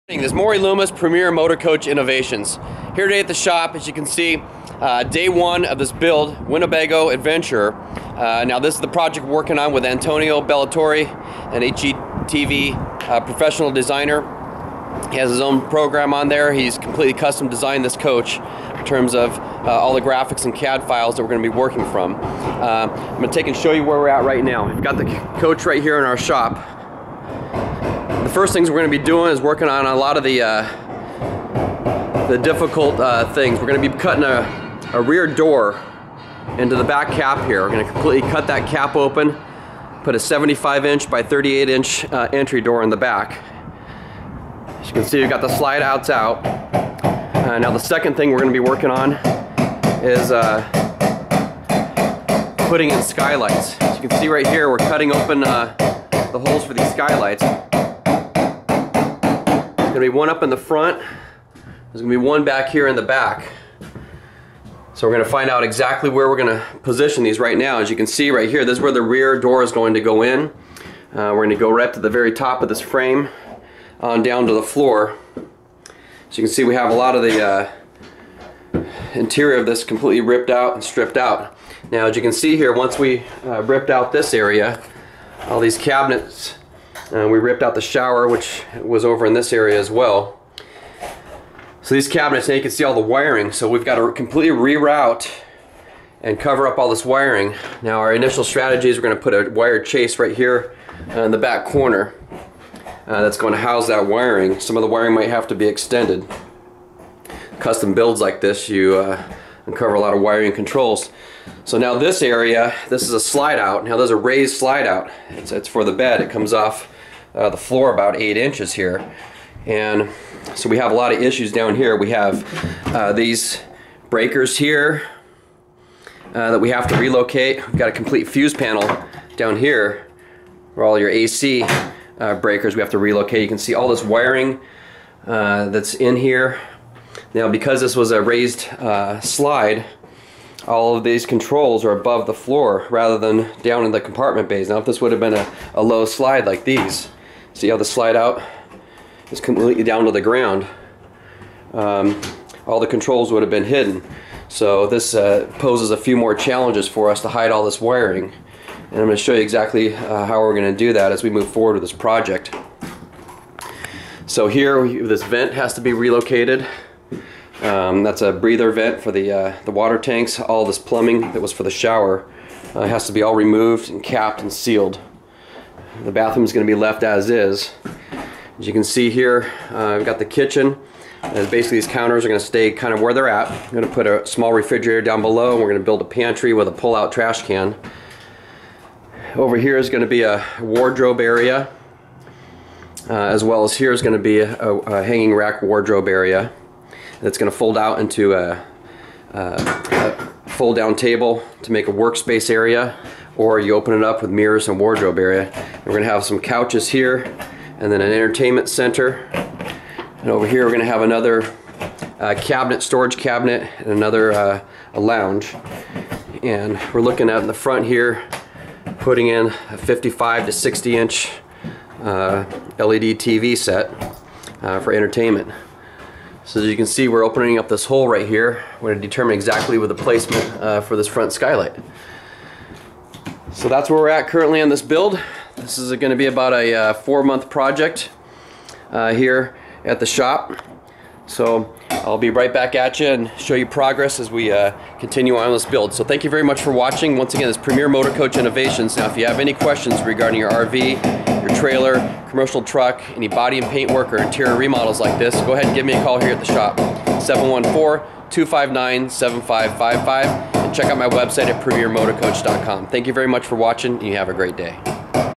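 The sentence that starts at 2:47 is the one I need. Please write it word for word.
Um, that's a breather vent for the, uh, the water tanks.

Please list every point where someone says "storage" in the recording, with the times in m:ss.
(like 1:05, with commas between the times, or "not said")
3:32.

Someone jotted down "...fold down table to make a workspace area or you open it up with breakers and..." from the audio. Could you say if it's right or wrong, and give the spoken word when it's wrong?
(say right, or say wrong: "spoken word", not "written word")
wrong: "mirrors", not "breakers".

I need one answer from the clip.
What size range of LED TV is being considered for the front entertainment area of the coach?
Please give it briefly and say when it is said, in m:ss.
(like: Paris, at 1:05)
55 to 60 inch, at 3:39.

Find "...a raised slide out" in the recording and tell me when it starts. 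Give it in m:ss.
1:54.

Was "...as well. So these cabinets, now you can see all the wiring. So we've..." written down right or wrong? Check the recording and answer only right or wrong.
right.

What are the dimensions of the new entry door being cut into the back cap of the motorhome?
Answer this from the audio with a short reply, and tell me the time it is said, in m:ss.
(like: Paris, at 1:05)
75 x 38 inches, at 0:40.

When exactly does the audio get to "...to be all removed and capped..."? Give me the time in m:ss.
2:53.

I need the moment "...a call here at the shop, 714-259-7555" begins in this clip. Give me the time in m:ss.
4:15.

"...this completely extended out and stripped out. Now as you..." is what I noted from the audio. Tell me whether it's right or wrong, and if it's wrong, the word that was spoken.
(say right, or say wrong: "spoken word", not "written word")
wrong: "ripped", not "extended".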